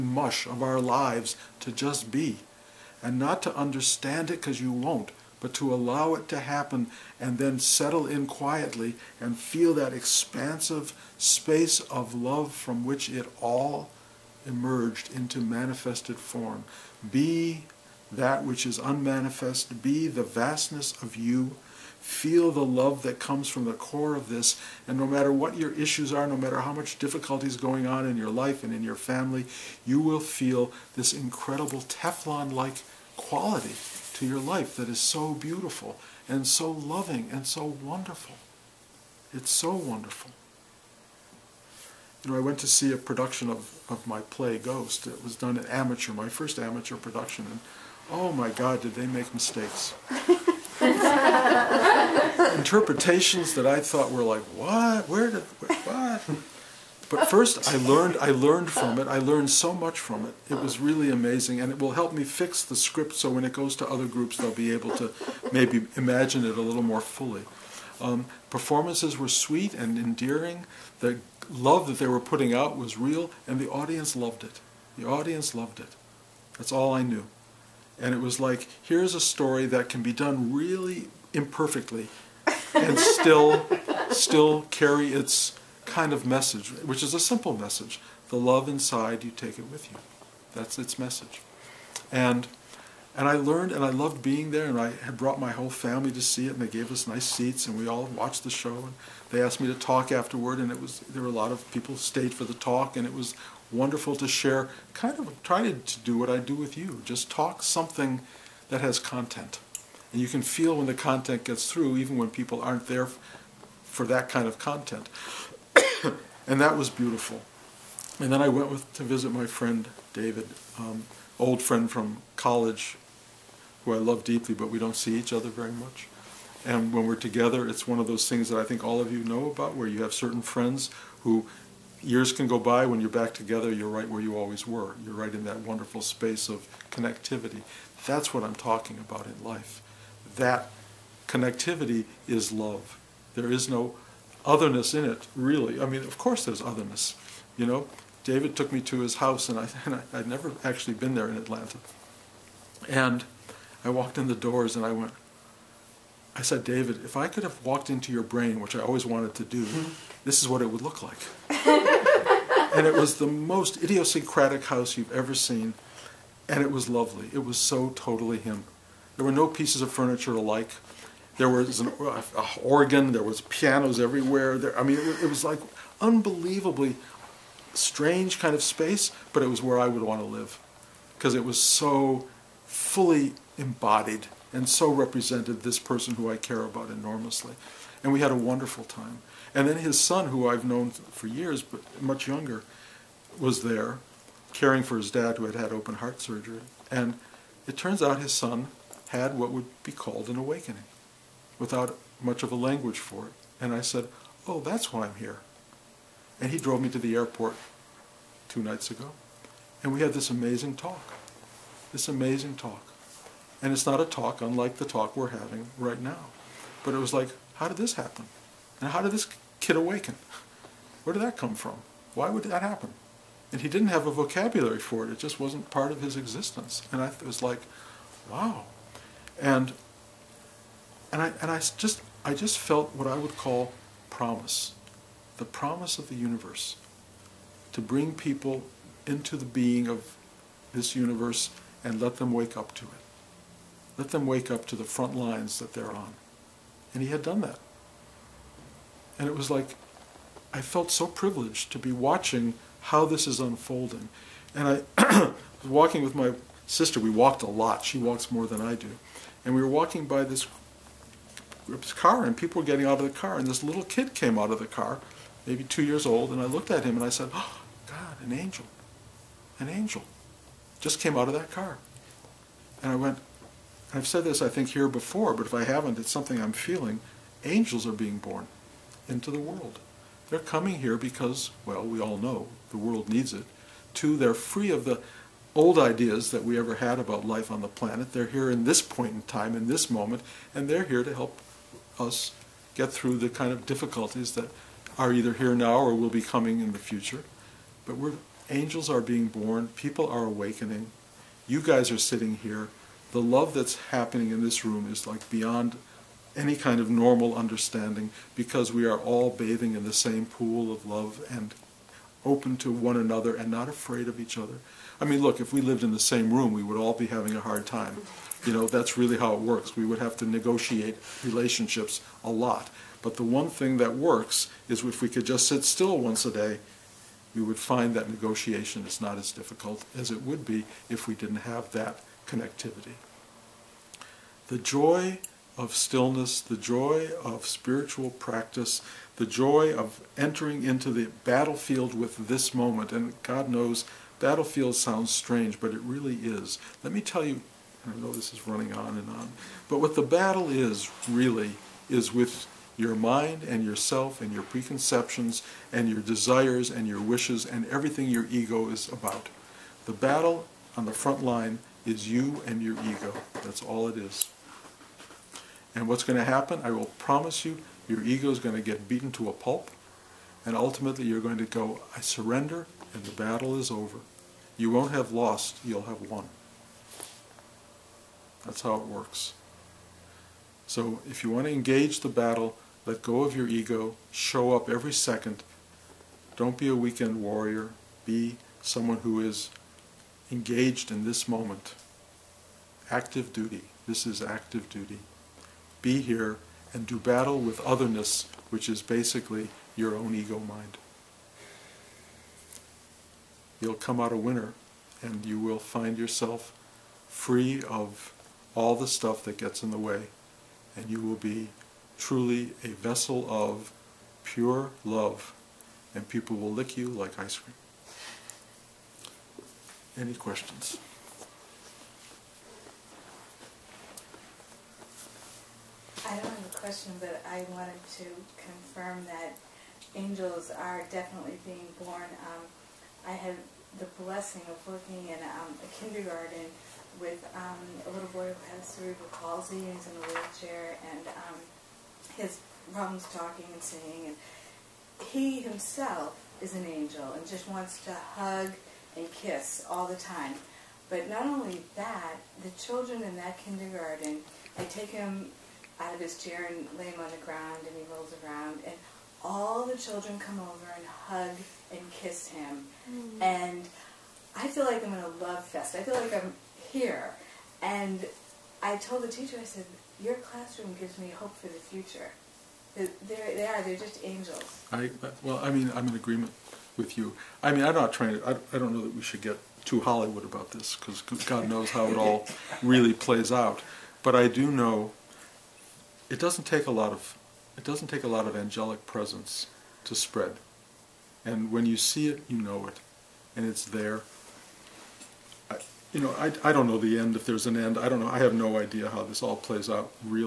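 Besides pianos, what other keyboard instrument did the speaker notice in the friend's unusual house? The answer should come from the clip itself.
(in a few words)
An organ.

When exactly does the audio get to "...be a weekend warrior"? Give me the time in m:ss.
6:26.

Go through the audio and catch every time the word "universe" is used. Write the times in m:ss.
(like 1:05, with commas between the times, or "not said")
3:56, 4:00.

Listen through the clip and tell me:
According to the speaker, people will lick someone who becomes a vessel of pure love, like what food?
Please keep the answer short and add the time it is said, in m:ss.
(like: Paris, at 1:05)
Ice cream, at 6:57.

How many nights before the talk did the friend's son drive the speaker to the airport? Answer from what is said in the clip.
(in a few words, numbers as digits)
2.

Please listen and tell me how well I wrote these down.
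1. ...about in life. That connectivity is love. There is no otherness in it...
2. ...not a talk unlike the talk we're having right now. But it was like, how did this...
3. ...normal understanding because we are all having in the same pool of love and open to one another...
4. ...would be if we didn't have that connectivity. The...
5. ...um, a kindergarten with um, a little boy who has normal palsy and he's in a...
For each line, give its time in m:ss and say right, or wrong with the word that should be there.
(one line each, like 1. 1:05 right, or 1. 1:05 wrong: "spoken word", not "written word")
1. 2:18 right
2. 3:33 right
3. 5:06 wrong: "bathing", not "having"
4. 5:30 right
5. 7:15 wrong: "cerebral", not "normal".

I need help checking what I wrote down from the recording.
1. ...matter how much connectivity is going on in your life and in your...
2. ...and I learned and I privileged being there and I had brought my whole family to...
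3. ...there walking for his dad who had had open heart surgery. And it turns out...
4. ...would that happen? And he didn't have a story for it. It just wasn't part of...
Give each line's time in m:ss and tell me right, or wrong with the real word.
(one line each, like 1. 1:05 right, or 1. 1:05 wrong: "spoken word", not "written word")
1. 0:26 wrong: "difficulty", not "connectivity"
2. 1:33 wrong: "loved", not "privileged"
3. 3:13 wrong: "caring", not "walking"
4. 3:42 wrong: "vocabulary", not "story".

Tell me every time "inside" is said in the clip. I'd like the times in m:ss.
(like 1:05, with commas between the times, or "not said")
1:28.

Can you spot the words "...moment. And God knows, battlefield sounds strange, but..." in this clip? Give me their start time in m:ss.
5:42.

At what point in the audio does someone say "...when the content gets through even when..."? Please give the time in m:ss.
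1:50.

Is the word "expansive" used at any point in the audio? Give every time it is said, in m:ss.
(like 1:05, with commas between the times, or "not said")
0:09.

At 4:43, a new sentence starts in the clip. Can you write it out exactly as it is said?
Two, they're free of the old ideas that we ever had about life on the planet.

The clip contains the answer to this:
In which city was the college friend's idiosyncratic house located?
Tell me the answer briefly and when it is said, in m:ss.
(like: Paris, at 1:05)
Atlanta, at 2:31.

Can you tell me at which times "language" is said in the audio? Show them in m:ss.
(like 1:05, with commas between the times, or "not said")
3:22.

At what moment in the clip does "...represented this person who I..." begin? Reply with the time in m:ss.
3:04.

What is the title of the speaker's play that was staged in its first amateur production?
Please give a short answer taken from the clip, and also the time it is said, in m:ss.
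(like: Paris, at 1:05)
Ghost, at 0:44.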